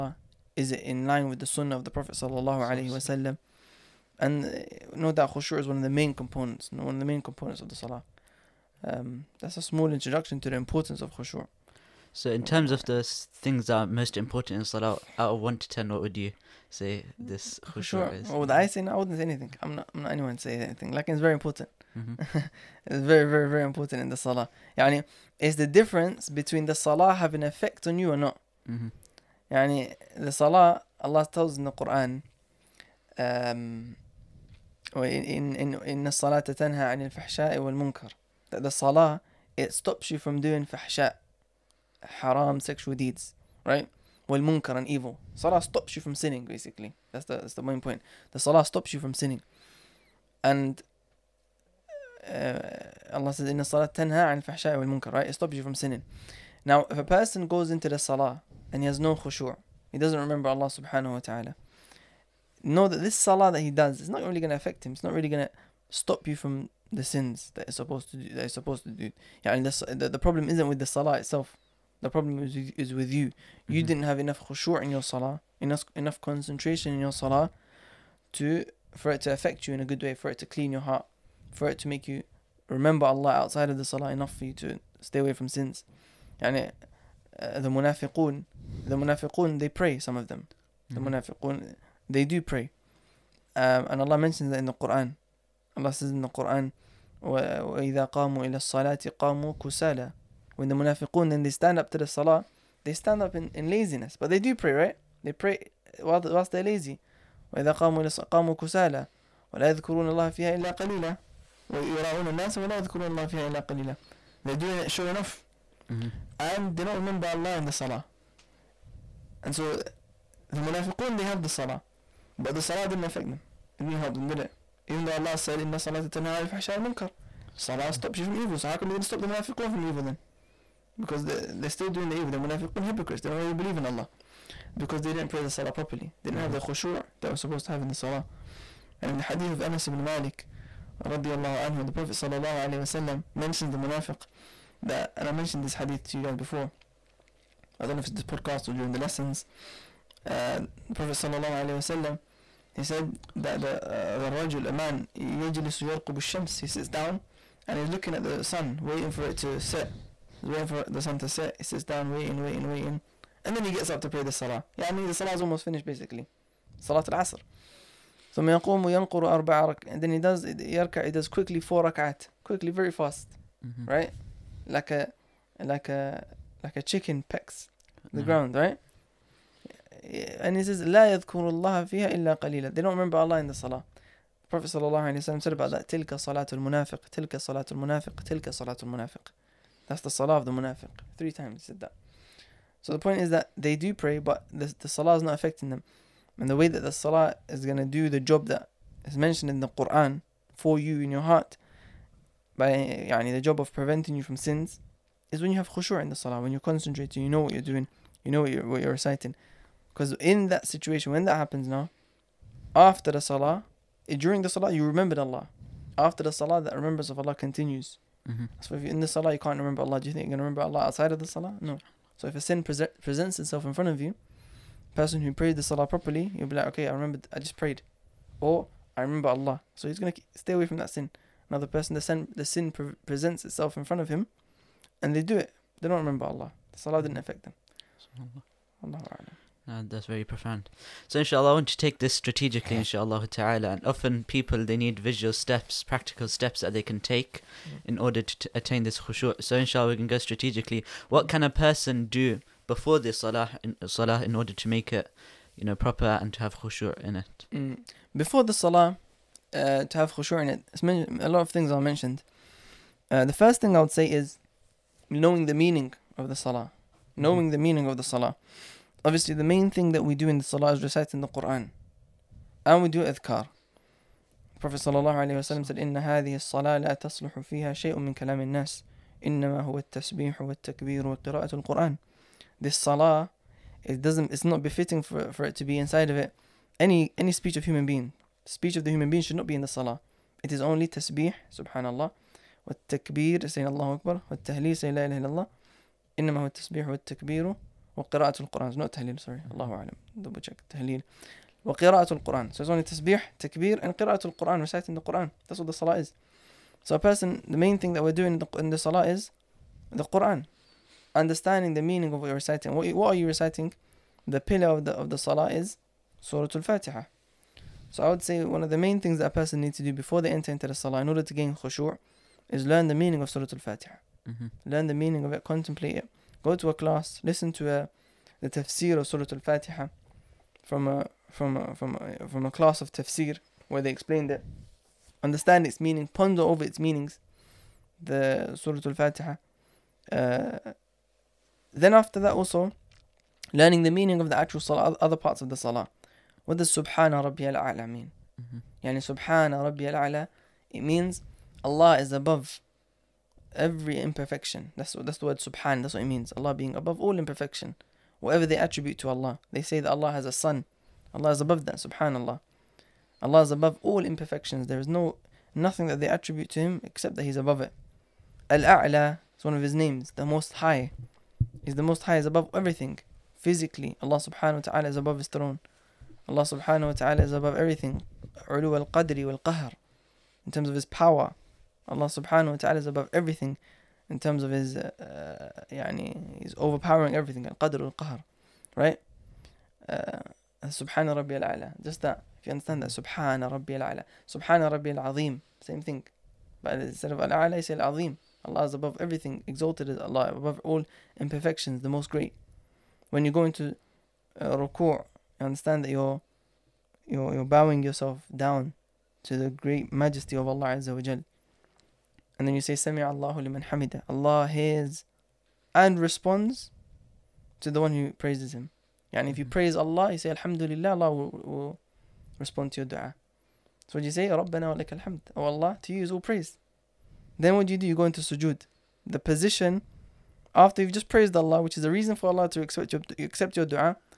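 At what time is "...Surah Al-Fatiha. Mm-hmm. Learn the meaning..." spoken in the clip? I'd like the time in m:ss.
5:23.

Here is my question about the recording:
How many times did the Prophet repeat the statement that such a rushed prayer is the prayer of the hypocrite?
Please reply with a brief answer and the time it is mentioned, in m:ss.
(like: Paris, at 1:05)
3, at 3:11.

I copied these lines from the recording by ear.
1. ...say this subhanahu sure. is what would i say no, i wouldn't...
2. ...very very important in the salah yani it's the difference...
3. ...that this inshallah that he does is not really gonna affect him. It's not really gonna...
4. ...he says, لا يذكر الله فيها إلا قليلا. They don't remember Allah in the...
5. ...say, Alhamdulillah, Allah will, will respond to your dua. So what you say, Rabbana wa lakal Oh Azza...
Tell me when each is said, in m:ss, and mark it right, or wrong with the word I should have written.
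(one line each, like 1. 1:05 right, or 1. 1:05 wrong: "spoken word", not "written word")
1. 0:16 wrong: "khushu", not "subhanahu"
2. 0:23 right
3. 1:02 wrong: "salah", not "inshallah"
4. 3:00 right
5. 7:00 wrong: "Allah", not "Azza".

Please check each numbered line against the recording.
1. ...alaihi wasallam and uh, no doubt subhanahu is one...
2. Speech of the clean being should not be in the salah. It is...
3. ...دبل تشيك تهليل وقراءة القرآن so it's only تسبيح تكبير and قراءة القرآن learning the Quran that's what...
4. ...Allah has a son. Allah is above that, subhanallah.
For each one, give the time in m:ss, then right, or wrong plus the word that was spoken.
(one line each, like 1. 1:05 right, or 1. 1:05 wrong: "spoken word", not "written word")
1. 0:02 wrong: "khushu", not "subhanahu"
2. 4:48 wrong: "human", not "clean"
3. 5:00 wrong: "reciting", not "learning"
4. 5:59 right.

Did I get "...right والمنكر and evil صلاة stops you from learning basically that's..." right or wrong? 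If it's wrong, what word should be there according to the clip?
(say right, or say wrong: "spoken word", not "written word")
wrong: "sinning", not "learning".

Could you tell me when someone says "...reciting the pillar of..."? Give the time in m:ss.
5:13.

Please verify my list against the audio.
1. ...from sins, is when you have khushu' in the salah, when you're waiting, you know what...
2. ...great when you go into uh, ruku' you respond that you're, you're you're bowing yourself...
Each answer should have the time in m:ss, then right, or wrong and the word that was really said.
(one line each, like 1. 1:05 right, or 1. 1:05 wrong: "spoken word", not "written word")
1. 3:24 wrong: "concentrating", not "waiting"
2. 6:42 wrong: "understand", not "respond".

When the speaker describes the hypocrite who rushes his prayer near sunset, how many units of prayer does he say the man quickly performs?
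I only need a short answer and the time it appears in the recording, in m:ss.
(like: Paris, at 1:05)
4, at 2:49.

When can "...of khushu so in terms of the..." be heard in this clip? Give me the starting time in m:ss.
0:10.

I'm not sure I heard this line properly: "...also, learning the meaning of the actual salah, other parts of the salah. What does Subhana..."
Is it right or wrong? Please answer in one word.
right.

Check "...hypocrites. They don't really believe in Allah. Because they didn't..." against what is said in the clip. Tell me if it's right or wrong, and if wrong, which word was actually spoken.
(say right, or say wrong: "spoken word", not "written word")
right.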